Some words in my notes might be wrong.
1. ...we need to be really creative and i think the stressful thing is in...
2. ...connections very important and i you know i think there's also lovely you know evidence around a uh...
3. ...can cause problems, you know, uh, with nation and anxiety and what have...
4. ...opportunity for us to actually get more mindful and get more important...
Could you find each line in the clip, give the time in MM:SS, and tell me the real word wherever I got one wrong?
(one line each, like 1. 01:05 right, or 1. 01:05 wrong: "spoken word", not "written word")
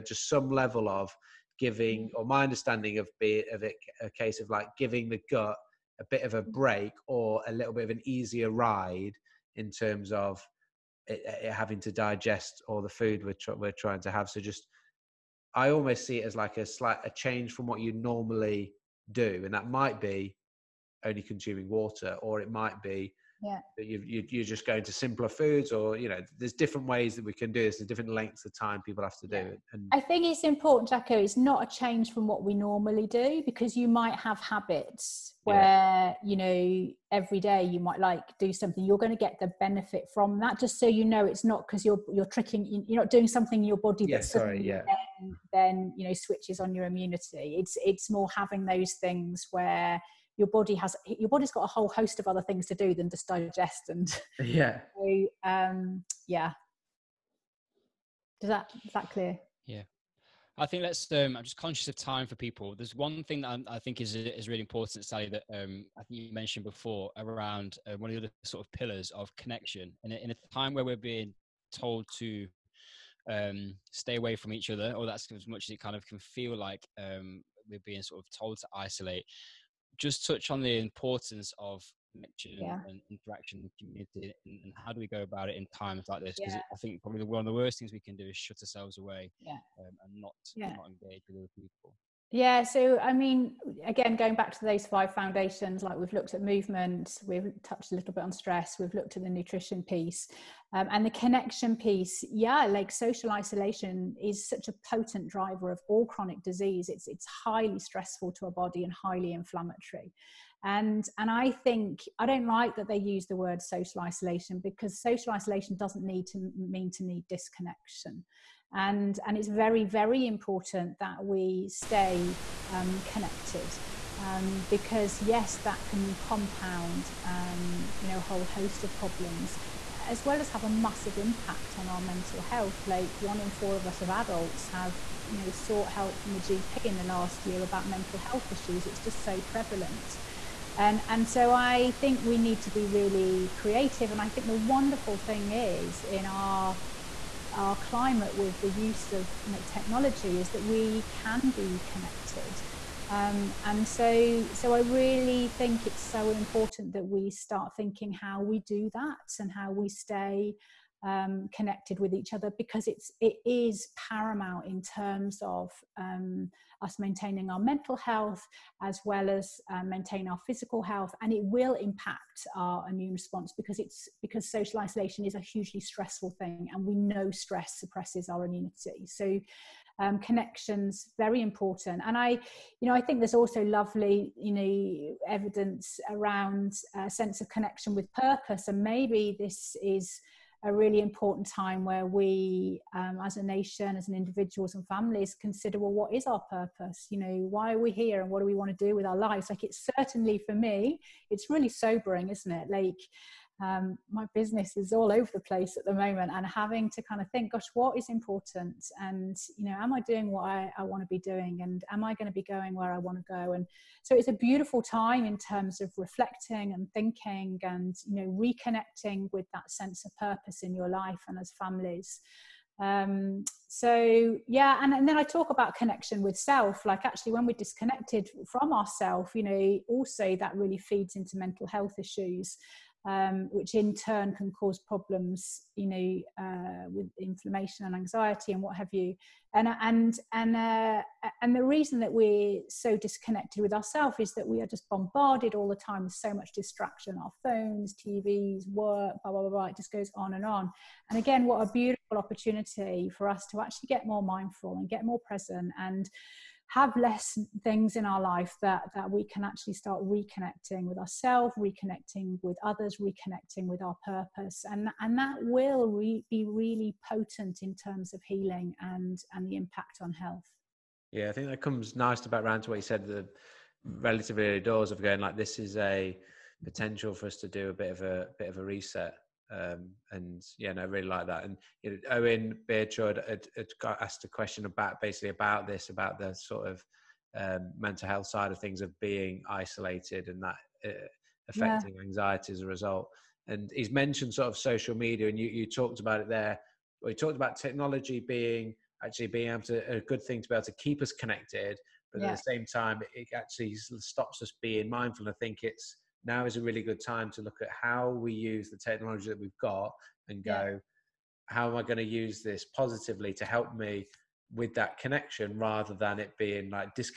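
1. 02:22 wrong: "wonderful", not "stressful"
2. 03:00 right
3. 03:54 wrong: "inflammation", not "nation"
4. 04:12 wrong: "present", not "important".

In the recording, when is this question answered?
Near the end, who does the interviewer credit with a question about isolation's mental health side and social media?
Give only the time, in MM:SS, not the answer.
04:42.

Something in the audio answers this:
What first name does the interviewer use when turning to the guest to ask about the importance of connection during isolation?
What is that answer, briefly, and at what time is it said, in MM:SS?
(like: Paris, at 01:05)
Sally, at 01:05.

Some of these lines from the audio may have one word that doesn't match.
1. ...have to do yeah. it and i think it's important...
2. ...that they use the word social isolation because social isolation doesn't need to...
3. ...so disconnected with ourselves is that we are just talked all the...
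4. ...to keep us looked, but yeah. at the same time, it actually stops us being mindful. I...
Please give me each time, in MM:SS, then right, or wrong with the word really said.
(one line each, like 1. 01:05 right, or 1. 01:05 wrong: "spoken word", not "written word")
1. 00:29 right
2. 01:52 right
3. 04:02 wrong: "bombarded", not "talked"
4. 05:00 wrong: "connected", not "looked".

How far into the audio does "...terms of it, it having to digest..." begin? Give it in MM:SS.
00:09.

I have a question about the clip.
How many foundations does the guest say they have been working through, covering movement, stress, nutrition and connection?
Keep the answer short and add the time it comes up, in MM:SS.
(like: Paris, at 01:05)
5, at 01:34.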